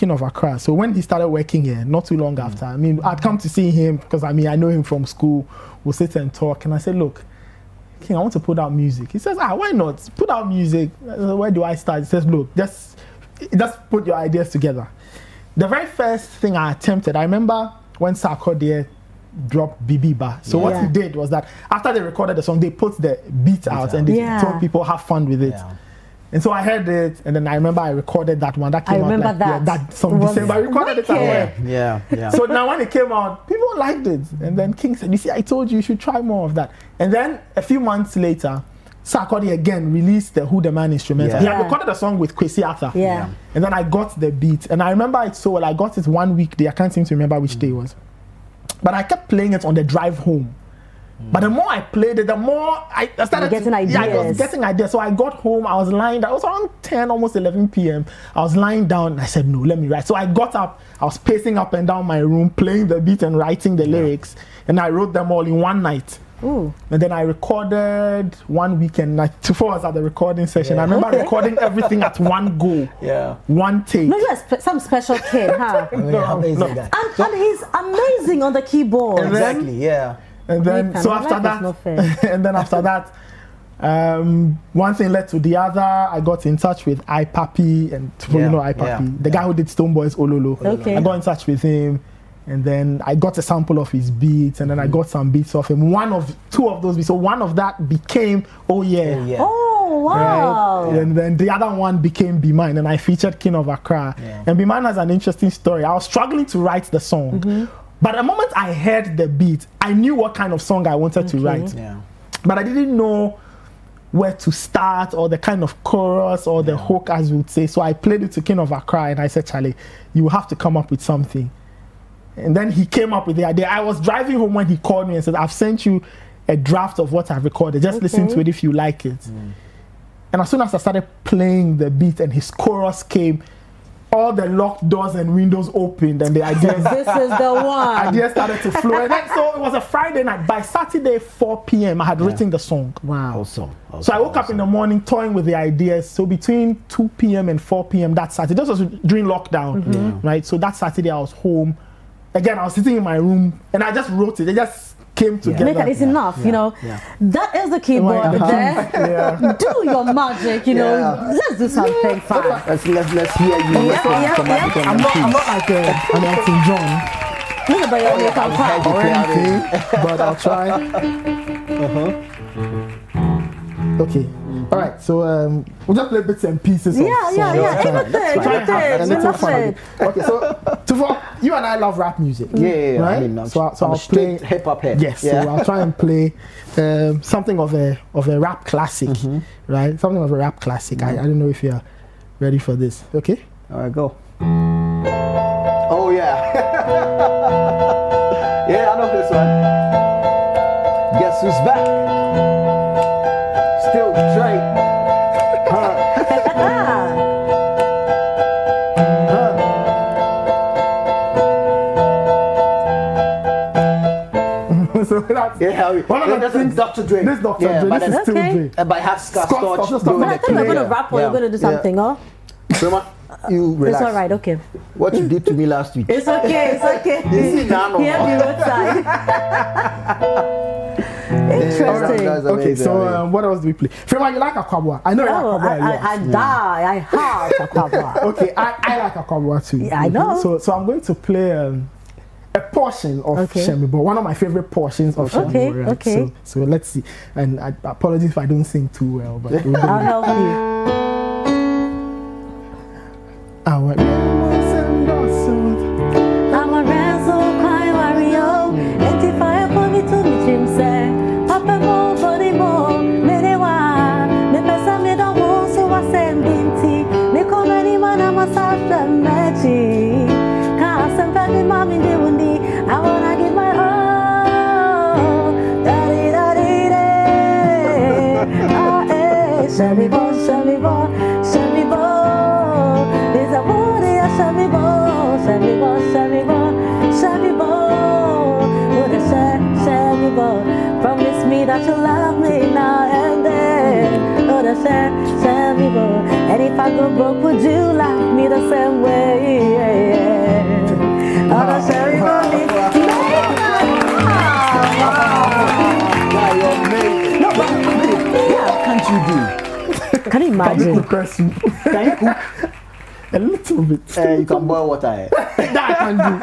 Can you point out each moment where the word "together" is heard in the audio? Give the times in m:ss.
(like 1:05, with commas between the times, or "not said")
0:14, 2:35.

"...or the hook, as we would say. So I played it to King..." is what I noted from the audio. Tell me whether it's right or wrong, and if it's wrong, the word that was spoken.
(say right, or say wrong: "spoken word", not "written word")
right.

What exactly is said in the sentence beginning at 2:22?
written the song wow awesome, awesome so i woke awesome.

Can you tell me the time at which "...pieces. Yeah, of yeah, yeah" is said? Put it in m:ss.
2:56.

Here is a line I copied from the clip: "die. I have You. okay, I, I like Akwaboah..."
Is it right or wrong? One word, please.
wrong.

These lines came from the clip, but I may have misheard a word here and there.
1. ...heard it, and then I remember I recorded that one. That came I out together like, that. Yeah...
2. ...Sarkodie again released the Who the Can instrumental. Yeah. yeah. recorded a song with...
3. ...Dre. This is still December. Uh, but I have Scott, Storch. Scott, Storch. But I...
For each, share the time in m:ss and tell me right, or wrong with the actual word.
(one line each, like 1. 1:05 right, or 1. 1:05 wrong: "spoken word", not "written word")
1. 0:26 wrong: "remember", not "together"
2. 0:39 wrong: "Man", not "Can"
3. 3:37 wrong: "Dre", not "December".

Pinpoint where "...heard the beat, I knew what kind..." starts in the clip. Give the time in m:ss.
1:48.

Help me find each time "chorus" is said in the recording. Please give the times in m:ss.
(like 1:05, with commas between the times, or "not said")
1:55, 2:12.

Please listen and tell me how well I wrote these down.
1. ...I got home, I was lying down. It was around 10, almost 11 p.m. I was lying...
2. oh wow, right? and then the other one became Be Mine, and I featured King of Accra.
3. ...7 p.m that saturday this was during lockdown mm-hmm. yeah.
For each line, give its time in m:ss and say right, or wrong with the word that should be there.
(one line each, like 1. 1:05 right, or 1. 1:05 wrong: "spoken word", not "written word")
1. 0:54 right
2. 1:39 right
3. 2:27 wrong: "4", not "7".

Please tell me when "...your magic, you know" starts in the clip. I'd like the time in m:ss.
2:39.